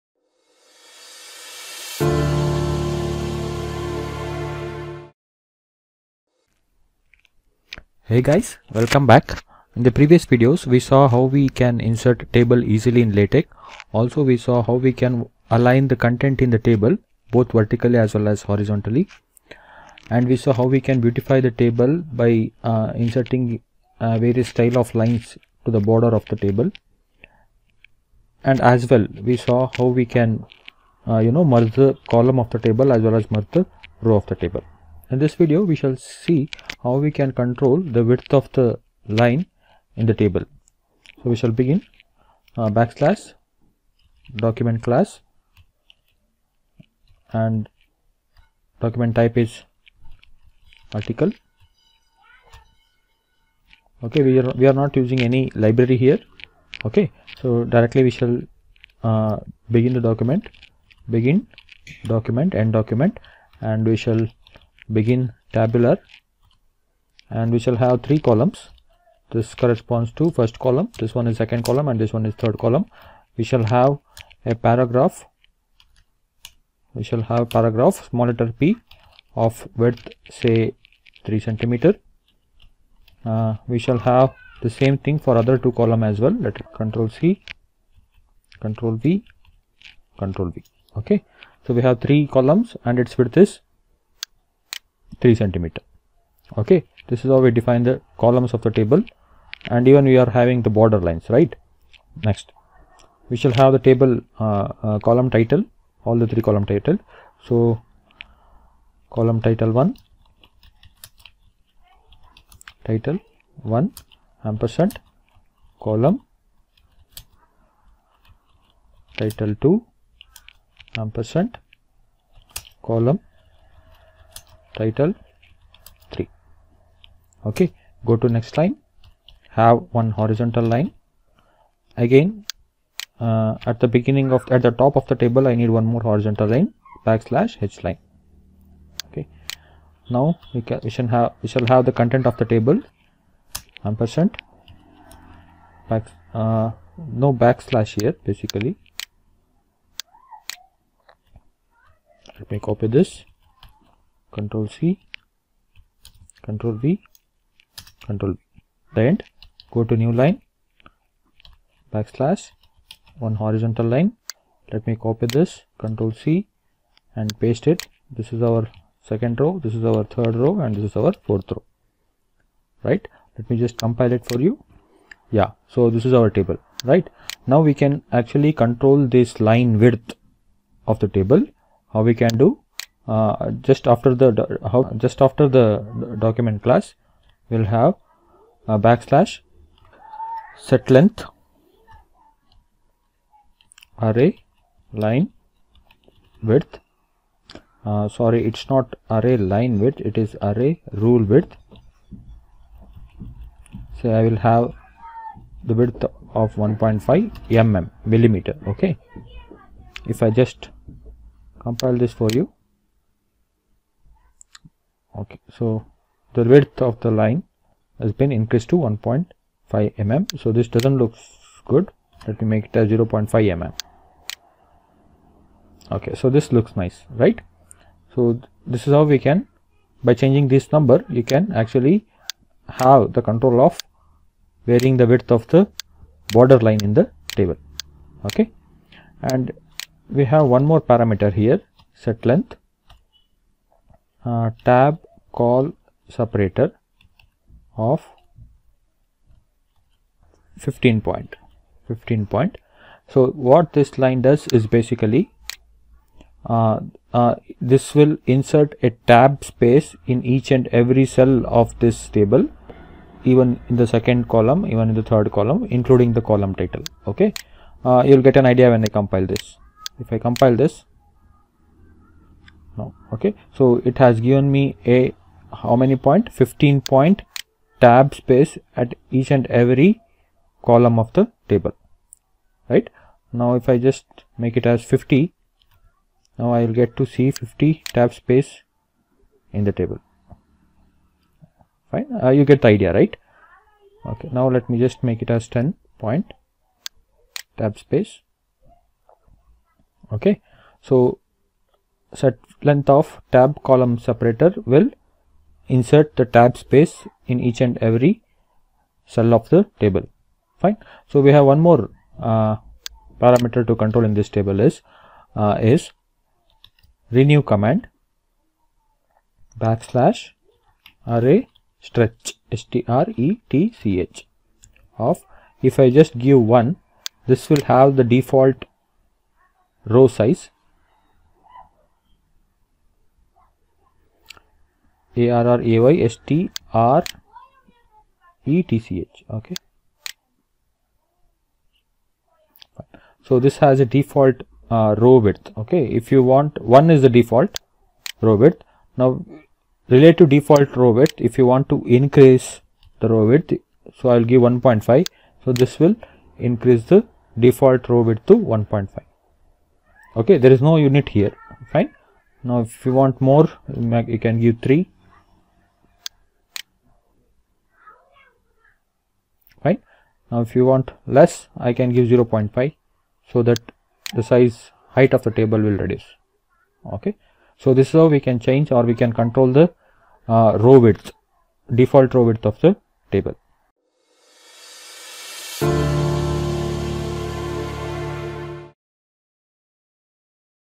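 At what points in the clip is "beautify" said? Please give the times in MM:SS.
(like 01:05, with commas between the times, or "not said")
00:20.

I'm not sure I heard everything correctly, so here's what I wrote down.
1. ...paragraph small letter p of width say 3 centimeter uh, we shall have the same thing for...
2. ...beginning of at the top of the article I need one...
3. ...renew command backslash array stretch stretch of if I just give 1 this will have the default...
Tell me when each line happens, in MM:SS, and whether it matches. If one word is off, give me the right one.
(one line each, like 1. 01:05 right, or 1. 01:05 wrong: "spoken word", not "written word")
1. 01:17 right
2. 02:13 wrong: "table", not "article"
3. 05:17 right.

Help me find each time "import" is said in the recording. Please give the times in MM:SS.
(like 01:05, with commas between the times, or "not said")
not said.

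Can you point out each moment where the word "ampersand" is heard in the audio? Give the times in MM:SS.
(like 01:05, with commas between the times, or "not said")
01:54, 02:01, 02:23.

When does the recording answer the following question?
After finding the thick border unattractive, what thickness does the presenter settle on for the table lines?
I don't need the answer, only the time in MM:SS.
03:42.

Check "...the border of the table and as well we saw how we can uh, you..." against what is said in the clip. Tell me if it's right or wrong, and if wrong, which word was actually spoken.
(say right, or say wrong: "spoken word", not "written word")
right.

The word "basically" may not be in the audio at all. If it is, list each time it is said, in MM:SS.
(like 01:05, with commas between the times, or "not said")
02:28, 04:14.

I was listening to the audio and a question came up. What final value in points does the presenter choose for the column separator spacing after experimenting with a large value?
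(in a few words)
10 point.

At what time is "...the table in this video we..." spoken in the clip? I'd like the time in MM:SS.
00:34.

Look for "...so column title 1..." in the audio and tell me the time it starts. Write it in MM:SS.
01:47.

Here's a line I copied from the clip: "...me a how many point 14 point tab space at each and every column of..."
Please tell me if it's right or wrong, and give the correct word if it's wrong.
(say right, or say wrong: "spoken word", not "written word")
wrong: "15", not "14".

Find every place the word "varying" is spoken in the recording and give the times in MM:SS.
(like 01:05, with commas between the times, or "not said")
03:54.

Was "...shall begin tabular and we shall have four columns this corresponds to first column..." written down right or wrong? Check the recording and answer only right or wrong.
wrong.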